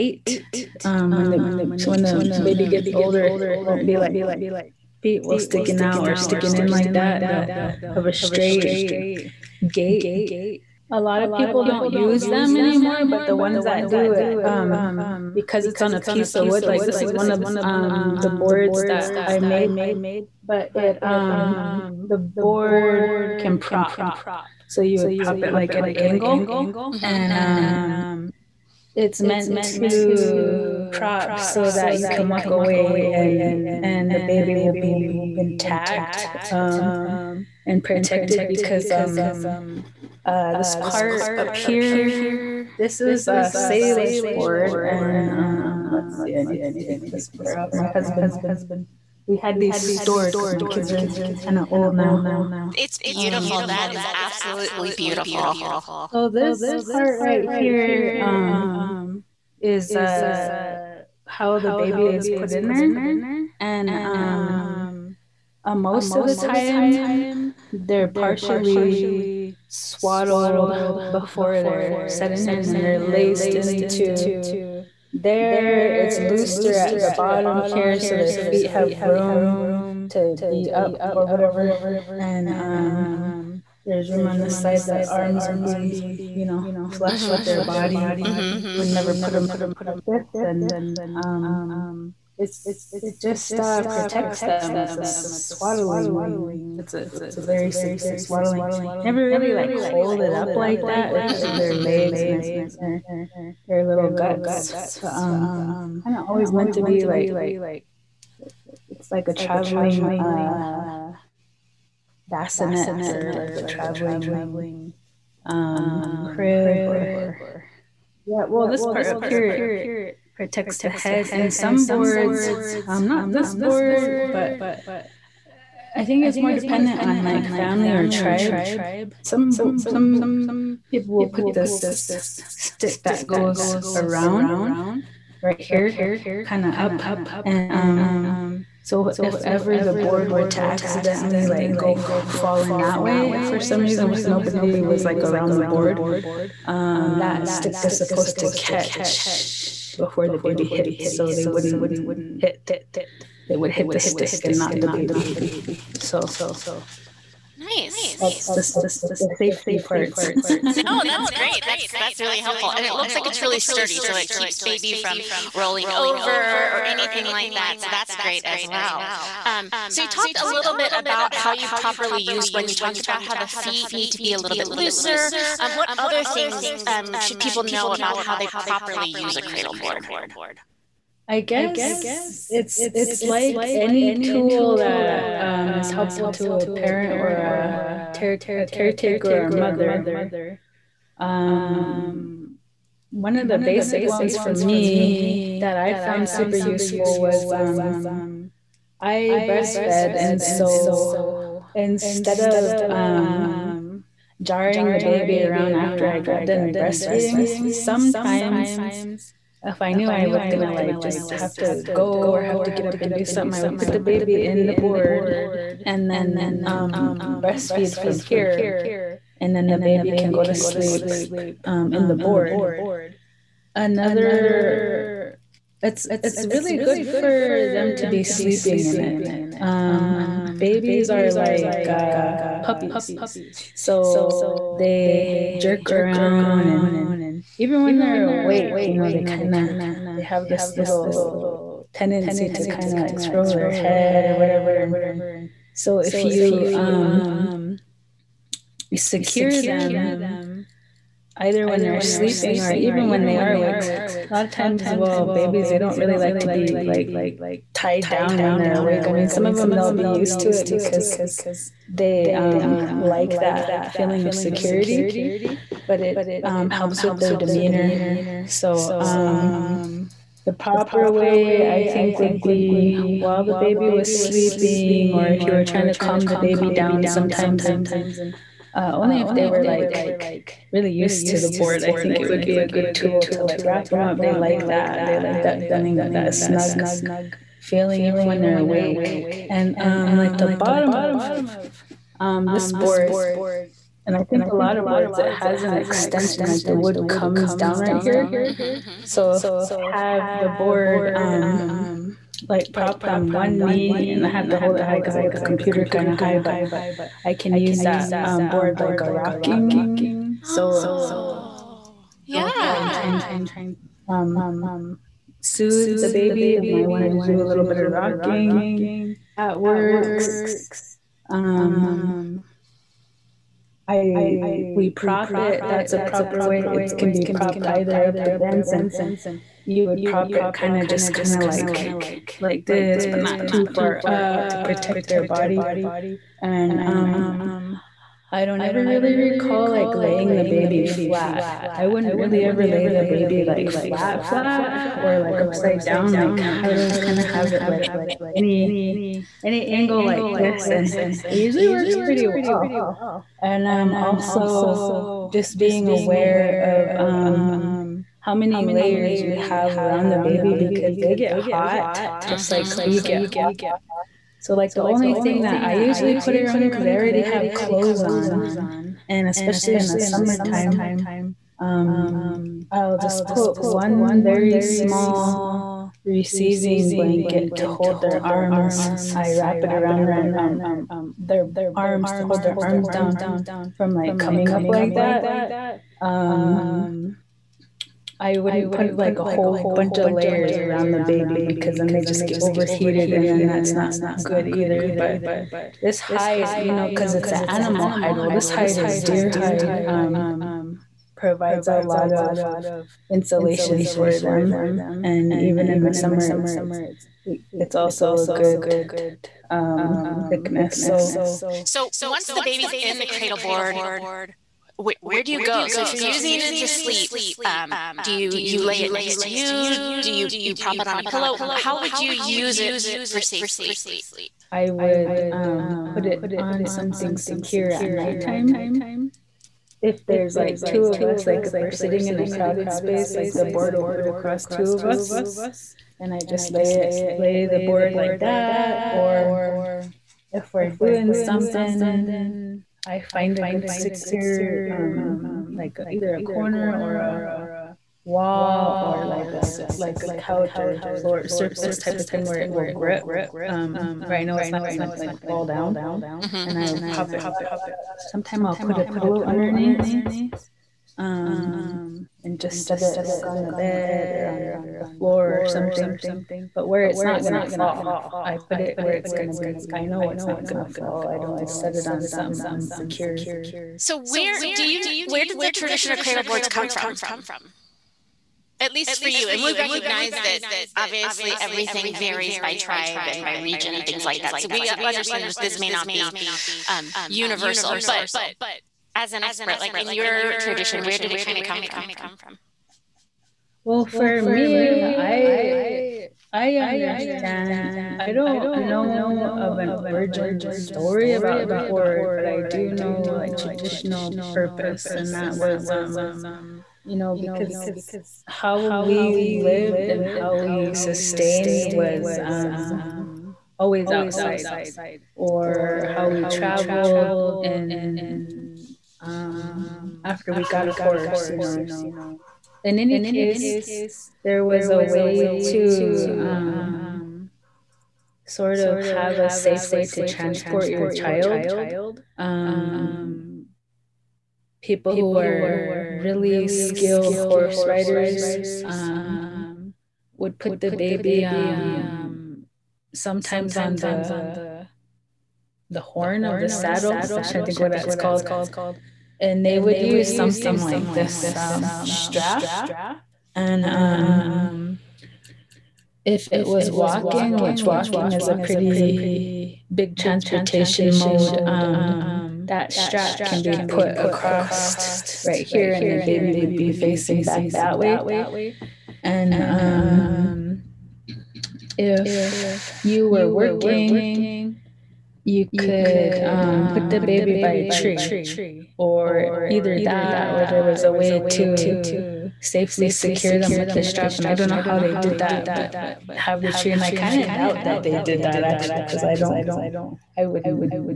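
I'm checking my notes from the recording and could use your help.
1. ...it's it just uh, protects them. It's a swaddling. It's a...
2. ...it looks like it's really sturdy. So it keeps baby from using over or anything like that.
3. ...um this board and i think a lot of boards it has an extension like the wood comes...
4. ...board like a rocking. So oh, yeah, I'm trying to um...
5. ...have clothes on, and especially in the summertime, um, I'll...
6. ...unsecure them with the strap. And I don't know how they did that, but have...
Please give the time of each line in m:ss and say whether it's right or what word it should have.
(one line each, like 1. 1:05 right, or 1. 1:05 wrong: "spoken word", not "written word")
1. 1:32 right
2. 2:42 wrong: "rolling", not "using"
3. 4:52 right
4. 5:08 right
5. 6:07 right
6. 9:42 wrong: "secure", not "unsecure".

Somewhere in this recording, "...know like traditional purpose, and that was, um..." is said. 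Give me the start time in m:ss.
8:22.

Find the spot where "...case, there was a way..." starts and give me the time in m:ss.
8:43.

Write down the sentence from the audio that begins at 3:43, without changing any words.
Another, it's it's really good for them to be sleeping in it.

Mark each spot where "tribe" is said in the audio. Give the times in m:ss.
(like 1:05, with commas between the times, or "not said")
2:08, 8:02.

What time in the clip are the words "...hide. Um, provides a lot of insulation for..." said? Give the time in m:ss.
6:39.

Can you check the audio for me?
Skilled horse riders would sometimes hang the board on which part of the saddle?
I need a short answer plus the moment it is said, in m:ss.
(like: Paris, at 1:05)
The horn, at 9:05.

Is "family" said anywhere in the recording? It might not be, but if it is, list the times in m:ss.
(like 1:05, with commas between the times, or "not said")
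2:07.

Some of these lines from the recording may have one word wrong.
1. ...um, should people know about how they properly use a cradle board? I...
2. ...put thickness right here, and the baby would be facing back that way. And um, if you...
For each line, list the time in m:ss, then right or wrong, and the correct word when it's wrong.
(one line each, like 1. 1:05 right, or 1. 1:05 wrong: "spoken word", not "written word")
1. 2:56 right
2. 9:23 wrong: "across", not "thickness".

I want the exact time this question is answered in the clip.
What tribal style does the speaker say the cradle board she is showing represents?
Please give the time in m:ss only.
0:43.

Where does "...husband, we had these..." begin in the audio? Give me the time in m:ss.
0:47.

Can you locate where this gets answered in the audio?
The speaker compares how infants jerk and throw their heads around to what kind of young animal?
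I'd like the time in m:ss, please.
3:52.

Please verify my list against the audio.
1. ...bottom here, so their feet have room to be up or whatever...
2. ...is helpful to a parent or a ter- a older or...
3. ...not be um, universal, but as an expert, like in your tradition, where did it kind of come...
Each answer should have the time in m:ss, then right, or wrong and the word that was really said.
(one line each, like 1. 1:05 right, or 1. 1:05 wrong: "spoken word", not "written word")
1. 1:17 right
2. 3:05 wrong: "caretaker", not "older"
3. 8:05 right.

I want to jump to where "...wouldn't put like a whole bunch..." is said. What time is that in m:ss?
6:28.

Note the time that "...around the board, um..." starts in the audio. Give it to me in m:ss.
2:25.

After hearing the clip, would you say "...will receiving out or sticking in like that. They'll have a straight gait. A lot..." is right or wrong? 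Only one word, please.
wrong.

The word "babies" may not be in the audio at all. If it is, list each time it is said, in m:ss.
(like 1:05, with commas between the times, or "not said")
3:50, 4:15.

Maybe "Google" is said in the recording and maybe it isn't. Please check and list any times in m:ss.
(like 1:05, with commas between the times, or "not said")
not said.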